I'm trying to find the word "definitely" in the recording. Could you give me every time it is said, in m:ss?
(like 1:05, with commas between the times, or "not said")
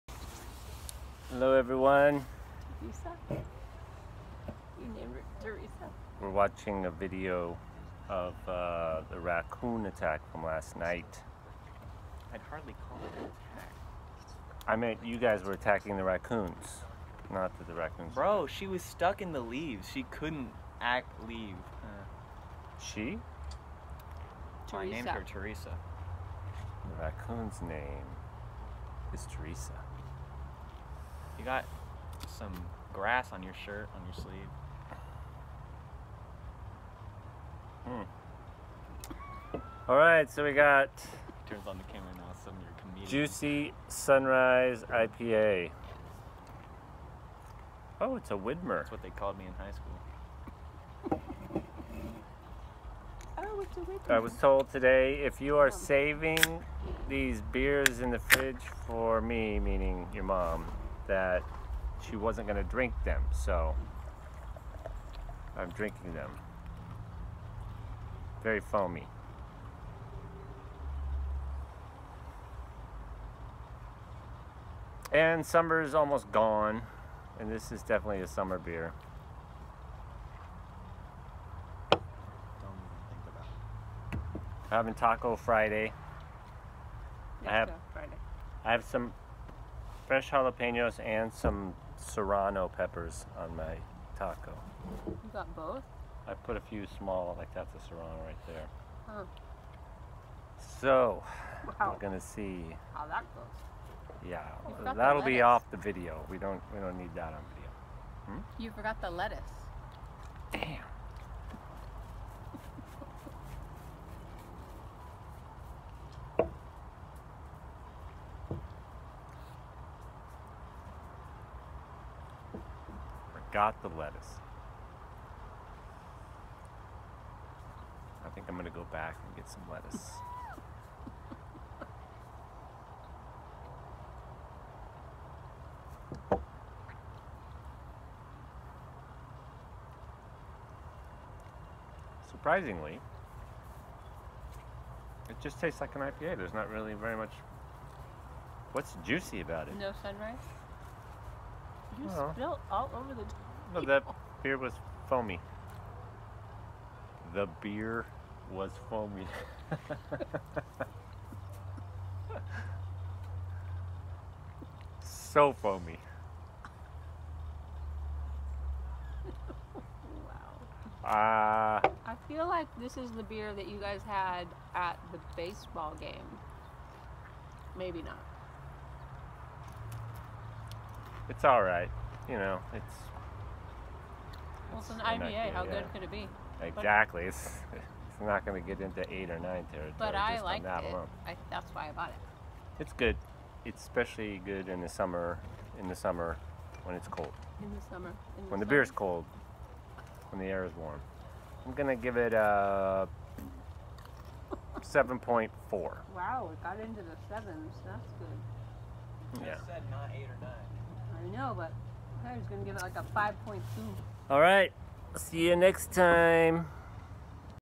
1:17.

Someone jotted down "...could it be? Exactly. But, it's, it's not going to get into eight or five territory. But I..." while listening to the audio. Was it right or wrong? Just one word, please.
wrong.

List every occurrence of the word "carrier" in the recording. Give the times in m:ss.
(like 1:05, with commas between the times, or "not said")
not said.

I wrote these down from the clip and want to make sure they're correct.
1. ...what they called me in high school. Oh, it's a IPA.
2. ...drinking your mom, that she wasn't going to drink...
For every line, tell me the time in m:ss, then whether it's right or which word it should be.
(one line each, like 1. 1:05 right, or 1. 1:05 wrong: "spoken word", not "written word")
1. 0:48 wrong: "Widmer", not "IPA"
2. 0:59 wrong: "meaning", not "drinking".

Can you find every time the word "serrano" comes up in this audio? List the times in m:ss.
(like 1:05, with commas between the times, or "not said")
1:31, 1:37.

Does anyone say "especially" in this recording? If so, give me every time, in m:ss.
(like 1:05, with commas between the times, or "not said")
3:13.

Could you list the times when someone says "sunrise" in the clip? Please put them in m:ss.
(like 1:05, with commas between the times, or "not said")
0:43, 2:30.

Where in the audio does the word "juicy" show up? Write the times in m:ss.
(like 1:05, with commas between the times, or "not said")
0:43, 2:29.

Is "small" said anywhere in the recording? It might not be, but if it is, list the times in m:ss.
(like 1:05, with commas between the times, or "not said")
1:36.